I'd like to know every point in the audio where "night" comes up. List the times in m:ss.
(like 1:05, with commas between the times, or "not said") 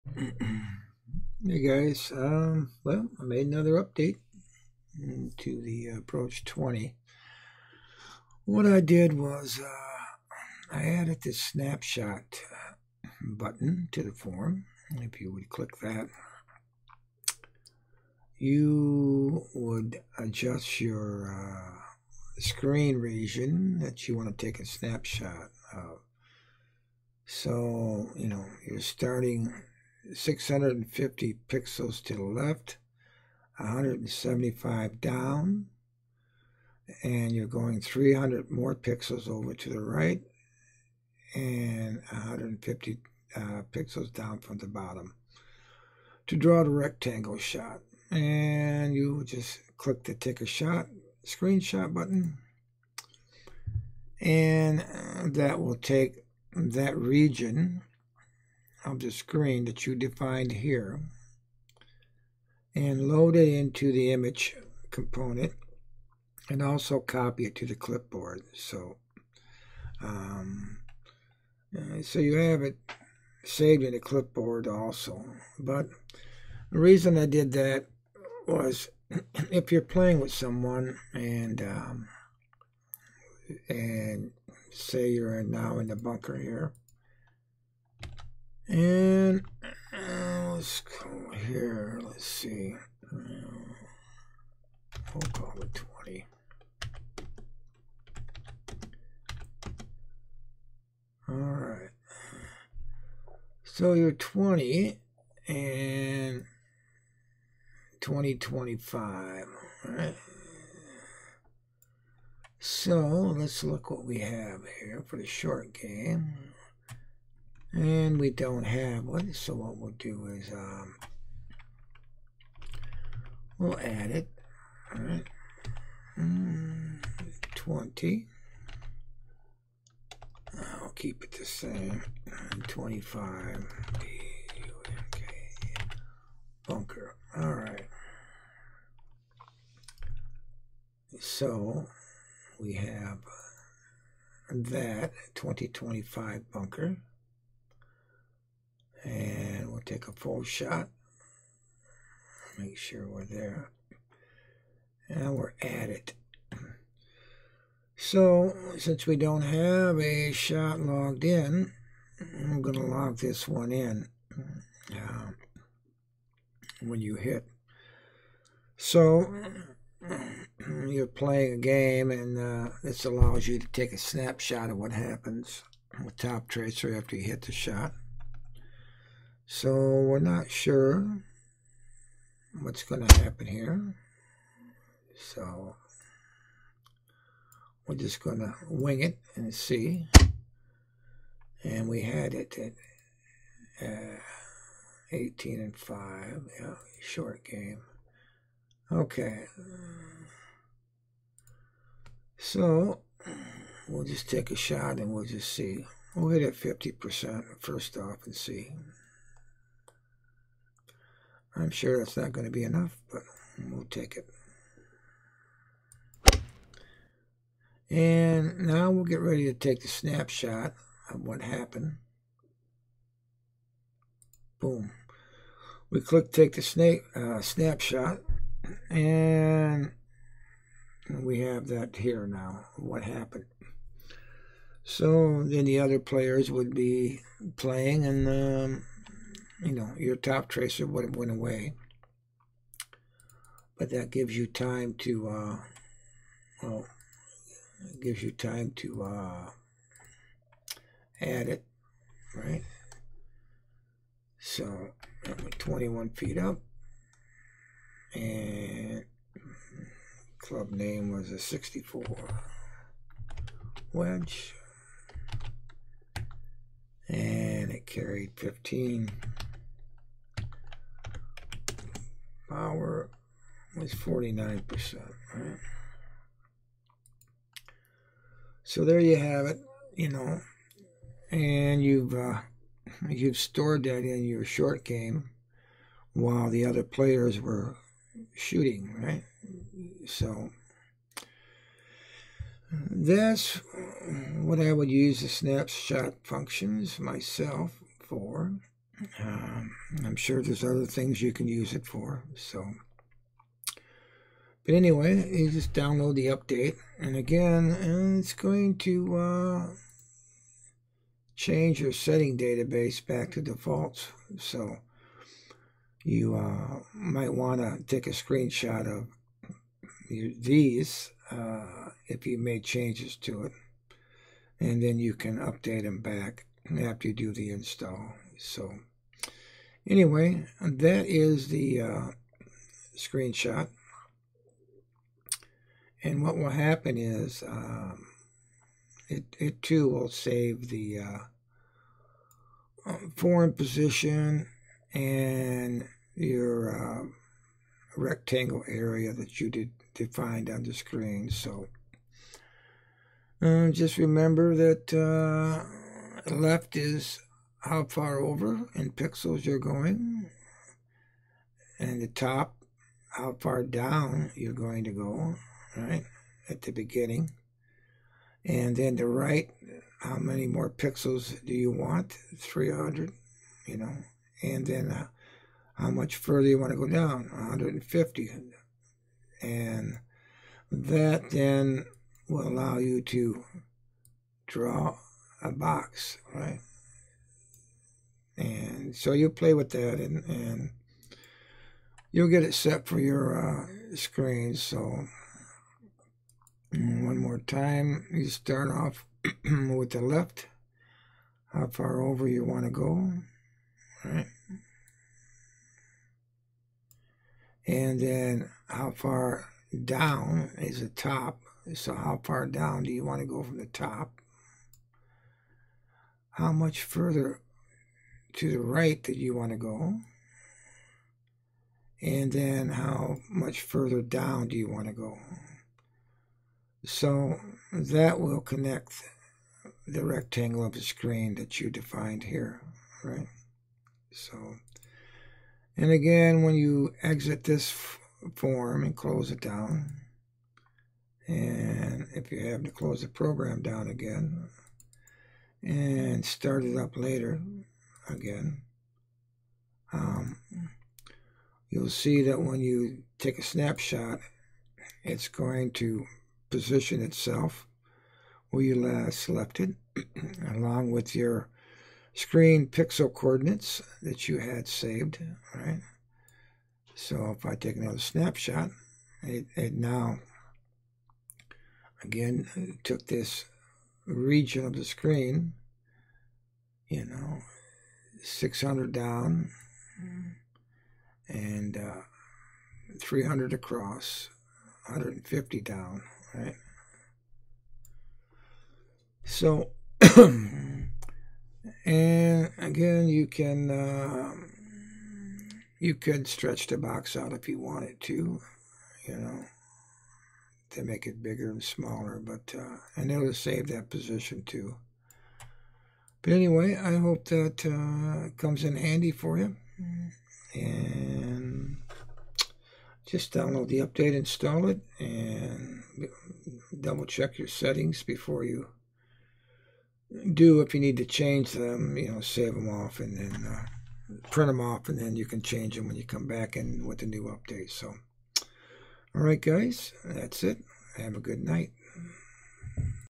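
8:51.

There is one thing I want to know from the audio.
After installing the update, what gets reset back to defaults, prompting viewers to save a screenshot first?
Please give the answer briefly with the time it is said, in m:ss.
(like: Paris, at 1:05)
setting database, at 5:11.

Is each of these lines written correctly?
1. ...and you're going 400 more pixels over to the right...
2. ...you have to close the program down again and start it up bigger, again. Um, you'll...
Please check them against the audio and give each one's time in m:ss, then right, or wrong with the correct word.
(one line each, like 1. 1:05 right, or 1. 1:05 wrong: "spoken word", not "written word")
1. 0:37 wrong: "300", not "400"
2. 7:22 wrong: "later", not "bigger".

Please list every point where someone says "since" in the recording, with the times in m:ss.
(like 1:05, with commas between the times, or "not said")
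2:38.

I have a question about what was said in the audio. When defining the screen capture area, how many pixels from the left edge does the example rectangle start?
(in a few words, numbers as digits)
650.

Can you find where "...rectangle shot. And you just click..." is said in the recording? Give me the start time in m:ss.
0:46.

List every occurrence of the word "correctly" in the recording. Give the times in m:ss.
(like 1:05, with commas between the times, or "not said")
not said.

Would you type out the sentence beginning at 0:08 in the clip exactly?
What I did was uh, I added this snapshot uh, button to the form.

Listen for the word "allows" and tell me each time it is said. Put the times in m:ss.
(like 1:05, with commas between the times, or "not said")
2:53, 6:22.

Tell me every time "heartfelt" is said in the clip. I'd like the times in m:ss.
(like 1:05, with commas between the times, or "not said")
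not said.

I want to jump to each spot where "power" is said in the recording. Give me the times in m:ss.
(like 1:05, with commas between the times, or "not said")
4:32.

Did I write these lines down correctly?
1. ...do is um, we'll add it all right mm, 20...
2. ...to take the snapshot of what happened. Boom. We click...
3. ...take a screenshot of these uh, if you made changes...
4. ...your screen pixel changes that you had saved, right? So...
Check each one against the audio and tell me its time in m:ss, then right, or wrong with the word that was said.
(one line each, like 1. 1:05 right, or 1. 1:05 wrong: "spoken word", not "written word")
1. 1:59 right
2. 3:39 right
3. 5:17 right
4. 7:41 wrong: "coordinates", not "changes".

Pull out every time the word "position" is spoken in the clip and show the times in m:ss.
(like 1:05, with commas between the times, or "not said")
5:43, 7:36, 8:23.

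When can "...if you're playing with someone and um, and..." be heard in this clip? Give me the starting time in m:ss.
1:19.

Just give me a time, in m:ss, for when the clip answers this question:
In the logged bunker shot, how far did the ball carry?
4:28.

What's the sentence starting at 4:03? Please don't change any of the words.
But that gives you time to, uh, well, gives you time to uh, add it, right?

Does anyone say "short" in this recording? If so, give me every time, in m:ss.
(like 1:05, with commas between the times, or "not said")
1:55, 3:17, 4:44.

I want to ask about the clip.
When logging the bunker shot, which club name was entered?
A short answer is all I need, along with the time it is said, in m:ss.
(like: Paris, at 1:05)
64 wedge, at 4:21.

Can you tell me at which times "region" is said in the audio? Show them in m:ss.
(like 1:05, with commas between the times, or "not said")
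0:22, 0:56, 7:54.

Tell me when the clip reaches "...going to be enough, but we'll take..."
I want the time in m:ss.
3:32.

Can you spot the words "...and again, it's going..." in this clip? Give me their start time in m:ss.
5:06.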